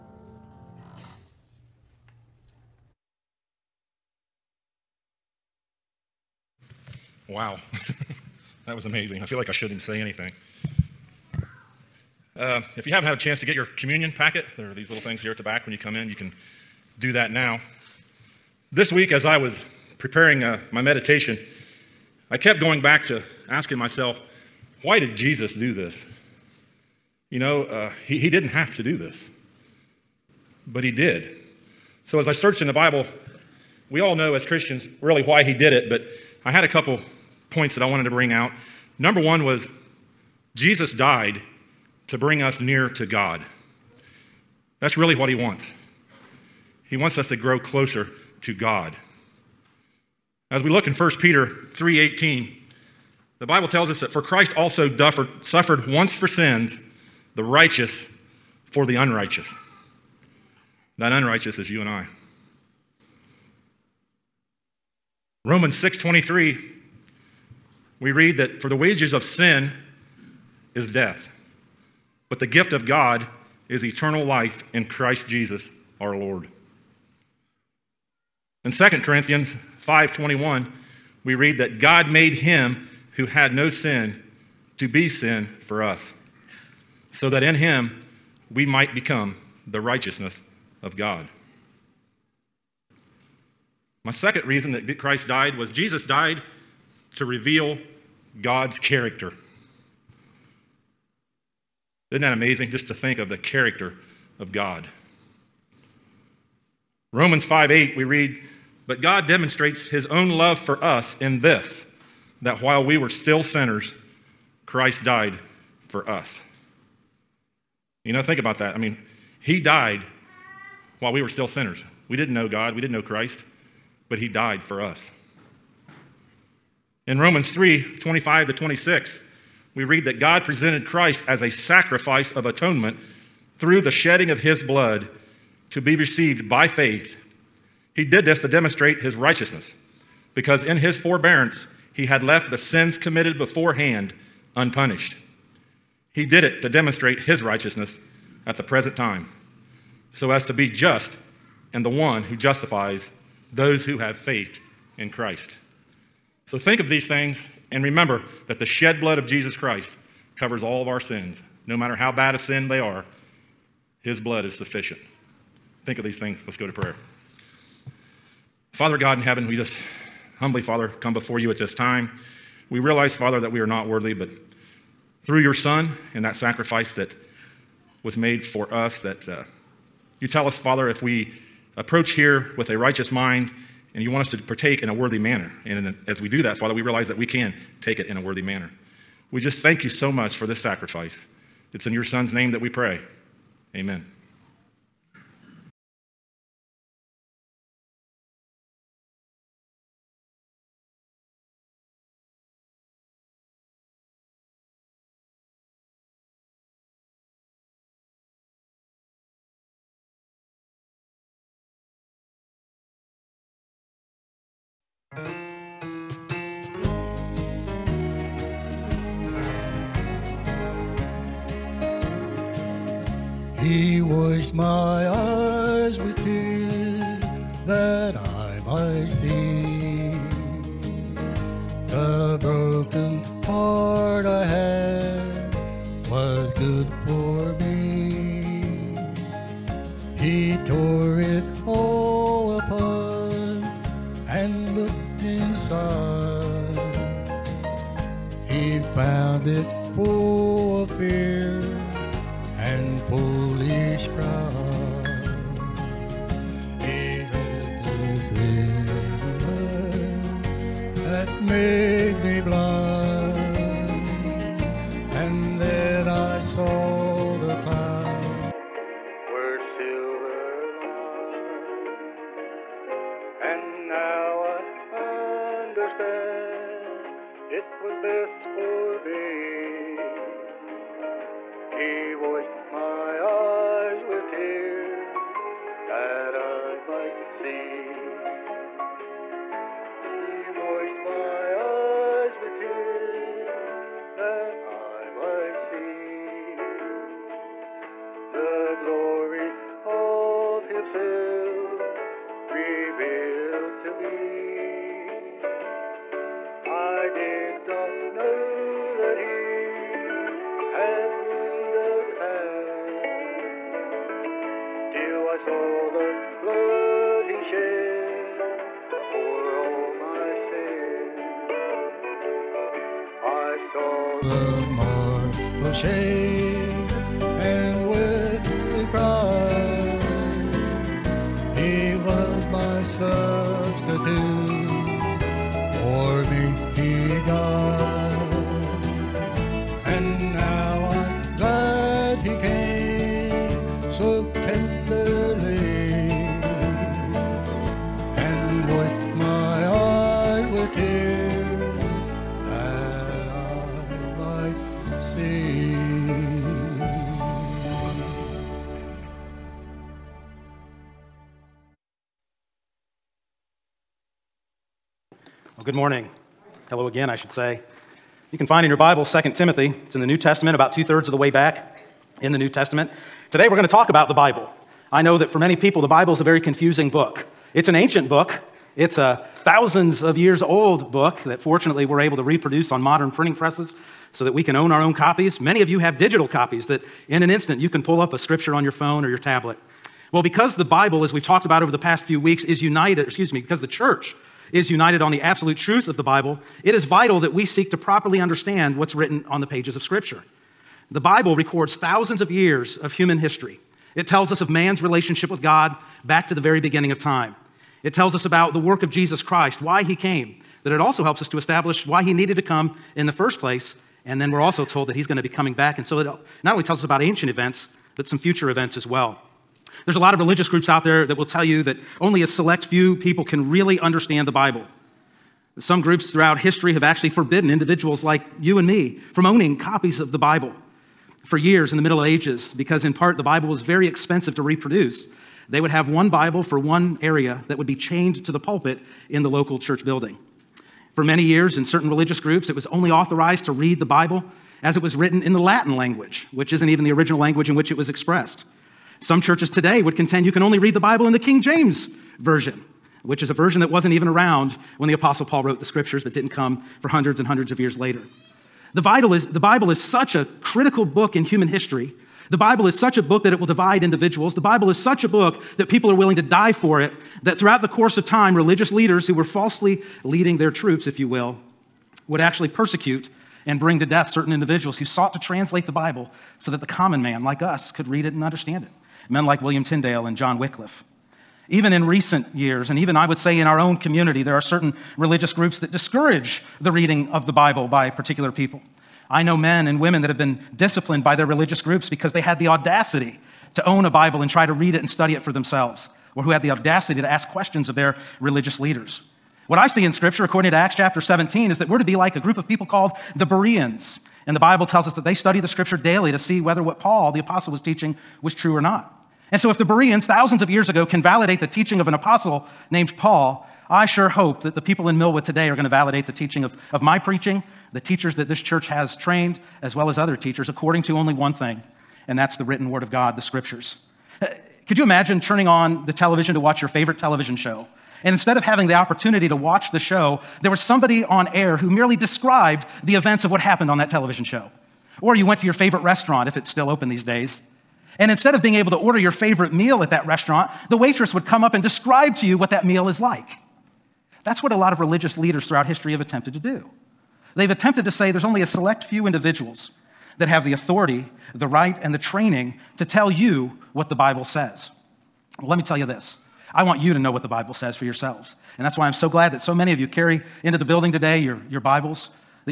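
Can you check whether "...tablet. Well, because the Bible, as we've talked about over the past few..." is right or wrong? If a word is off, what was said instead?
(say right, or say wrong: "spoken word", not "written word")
right.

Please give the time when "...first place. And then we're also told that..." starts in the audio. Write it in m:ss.
6:53.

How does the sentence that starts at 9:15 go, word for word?
Well, let me tell you this I want you to know what the Bible says for yourselves.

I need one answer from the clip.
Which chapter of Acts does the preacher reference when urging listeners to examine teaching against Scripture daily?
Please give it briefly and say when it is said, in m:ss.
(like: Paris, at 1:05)
Acts chapter 17, at 8:20.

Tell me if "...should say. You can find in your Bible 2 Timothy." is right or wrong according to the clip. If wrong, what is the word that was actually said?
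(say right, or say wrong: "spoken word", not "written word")
right.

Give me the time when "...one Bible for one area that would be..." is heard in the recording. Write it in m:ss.
7:15.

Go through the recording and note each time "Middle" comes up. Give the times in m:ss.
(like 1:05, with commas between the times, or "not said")
7:11.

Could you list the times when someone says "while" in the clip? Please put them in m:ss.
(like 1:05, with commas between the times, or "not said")
1:52, 2:01.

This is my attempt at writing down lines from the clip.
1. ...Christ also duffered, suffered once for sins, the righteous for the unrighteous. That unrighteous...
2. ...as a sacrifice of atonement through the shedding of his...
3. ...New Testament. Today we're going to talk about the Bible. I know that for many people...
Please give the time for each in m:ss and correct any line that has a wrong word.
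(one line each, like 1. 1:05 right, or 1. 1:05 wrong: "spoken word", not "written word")
1. 0:54 right
2. 2:11 right
3. 6:12 right.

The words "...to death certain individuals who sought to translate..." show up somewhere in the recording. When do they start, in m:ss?
7:53.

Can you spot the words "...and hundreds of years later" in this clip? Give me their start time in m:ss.
7:37.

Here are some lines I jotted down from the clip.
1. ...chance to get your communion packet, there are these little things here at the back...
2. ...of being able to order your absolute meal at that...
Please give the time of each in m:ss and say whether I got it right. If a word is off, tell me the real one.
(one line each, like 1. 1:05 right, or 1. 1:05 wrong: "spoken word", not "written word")
1. 0:13 right
2. 8:58 wrong: "favorite", not "absolute".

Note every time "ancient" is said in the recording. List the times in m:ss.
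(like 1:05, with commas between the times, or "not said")
6:17, 6:57.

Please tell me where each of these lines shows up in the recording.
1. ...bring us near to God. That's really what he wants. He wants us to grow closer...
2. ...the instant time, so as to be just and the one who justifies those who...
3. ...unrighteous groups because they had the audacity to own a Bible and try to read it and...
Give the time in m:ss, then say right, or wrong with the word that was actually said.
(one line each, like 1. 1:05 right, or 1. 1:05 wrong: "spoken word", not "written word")
1. 0:42 right
2. 2:28 wrong: "present", not "instant"
3. 8:11 wrong: "religious", not "unrighteous".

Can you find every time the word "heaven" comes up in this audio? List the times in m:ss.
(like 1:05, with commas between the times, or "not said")
2:49.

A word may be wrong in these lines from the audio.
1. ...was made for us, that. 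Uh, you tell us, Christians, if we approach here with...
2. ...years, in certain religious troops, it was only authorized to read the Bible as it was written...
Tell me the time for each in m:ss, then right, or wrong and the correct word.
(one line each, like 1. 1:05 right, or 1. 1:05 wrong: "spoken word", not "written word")
1. 2:58 wrong: "Father", not "Christians"
2. 7:21 wrong: "groups", not "troops".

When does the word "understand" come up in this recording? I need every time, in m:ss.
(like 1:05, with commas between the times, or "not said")
6:38, 7:03, 7:58.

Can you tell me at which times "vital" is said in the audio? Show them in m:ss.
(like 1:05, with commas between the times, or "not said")
6:36, 7:38.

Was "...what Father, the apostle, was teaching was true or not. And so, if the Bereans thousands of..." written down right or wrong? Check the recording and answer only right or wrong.
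wrong.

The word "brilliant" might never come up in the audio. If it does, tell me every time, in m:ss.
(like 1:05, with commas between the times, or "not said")
not said.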